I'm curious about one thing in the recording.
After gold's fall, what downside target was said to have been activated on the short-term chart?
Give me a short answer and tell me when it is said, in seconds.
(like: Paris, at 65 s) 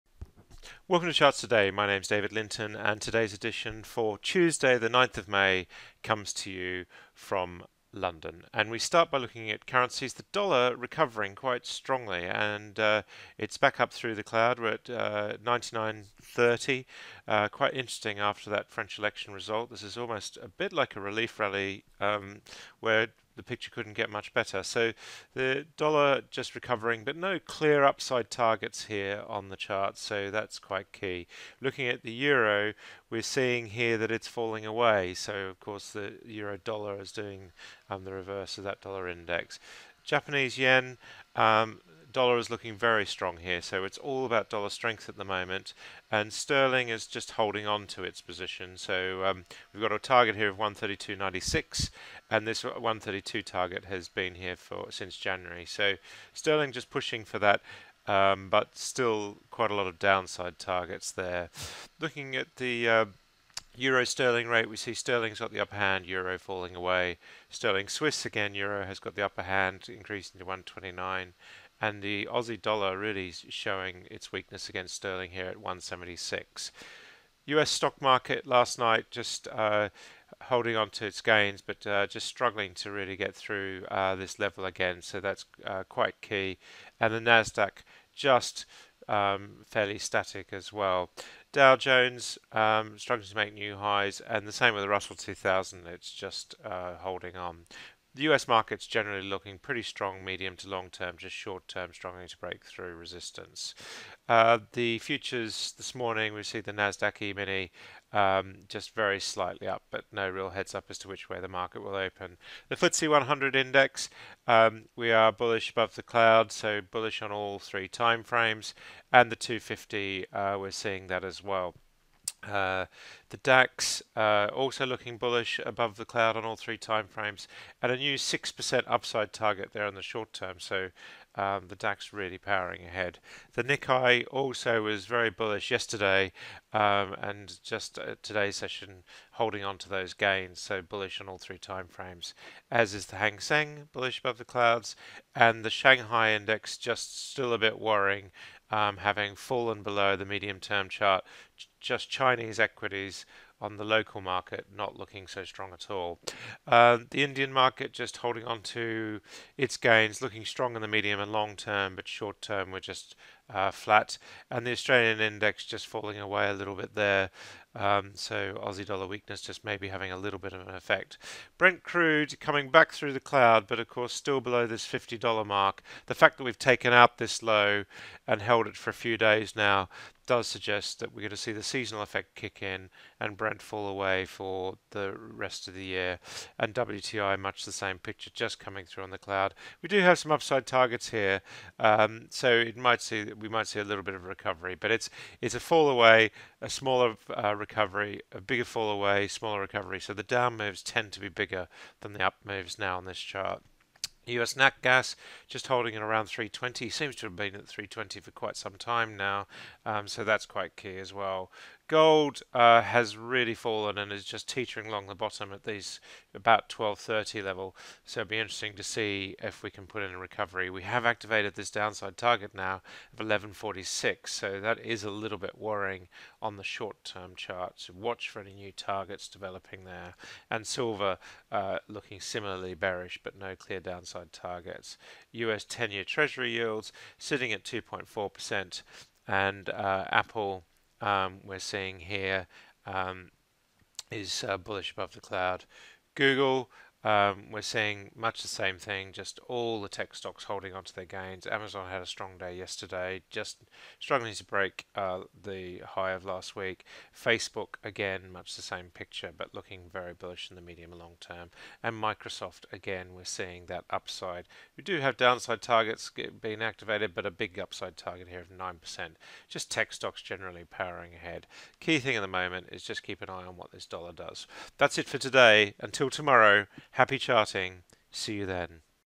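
1146, at 223 s.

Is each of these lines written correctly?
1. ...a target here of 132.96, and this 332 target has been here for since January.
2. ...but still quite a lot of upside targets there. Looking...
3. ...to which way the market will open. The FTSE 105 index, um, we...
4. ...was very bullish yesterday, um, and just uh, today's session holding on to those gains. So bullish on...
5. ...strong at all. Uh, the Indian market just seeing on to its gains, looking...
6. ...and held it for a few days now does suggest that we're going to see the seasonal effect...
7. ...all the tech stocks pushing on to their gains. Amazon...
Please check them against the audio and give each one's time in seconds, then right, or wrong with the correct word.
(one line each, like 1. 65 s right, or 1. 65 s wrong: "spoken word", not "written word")
1. 49 s wrong: "132", not "332"
2. 58 s wrong: "downside", not "upside"
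3. 110 s wrong: "100", not "105"
4. 134 s right
5. 155 s wrong: "holding", not "seeing"
6. 178 s right
7. 249 s wrong: "holding", not "pushing".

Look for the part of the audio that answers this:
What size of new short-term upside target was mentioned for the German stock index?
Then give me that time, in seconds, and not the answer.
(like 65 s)
128 s.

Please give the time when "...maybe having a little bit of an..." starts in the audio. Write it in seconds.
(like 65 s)
169 s.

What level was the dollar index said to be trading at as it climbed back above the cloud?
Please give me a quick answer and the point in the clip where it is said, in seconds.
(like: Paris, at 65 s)
99.30, at 15 s.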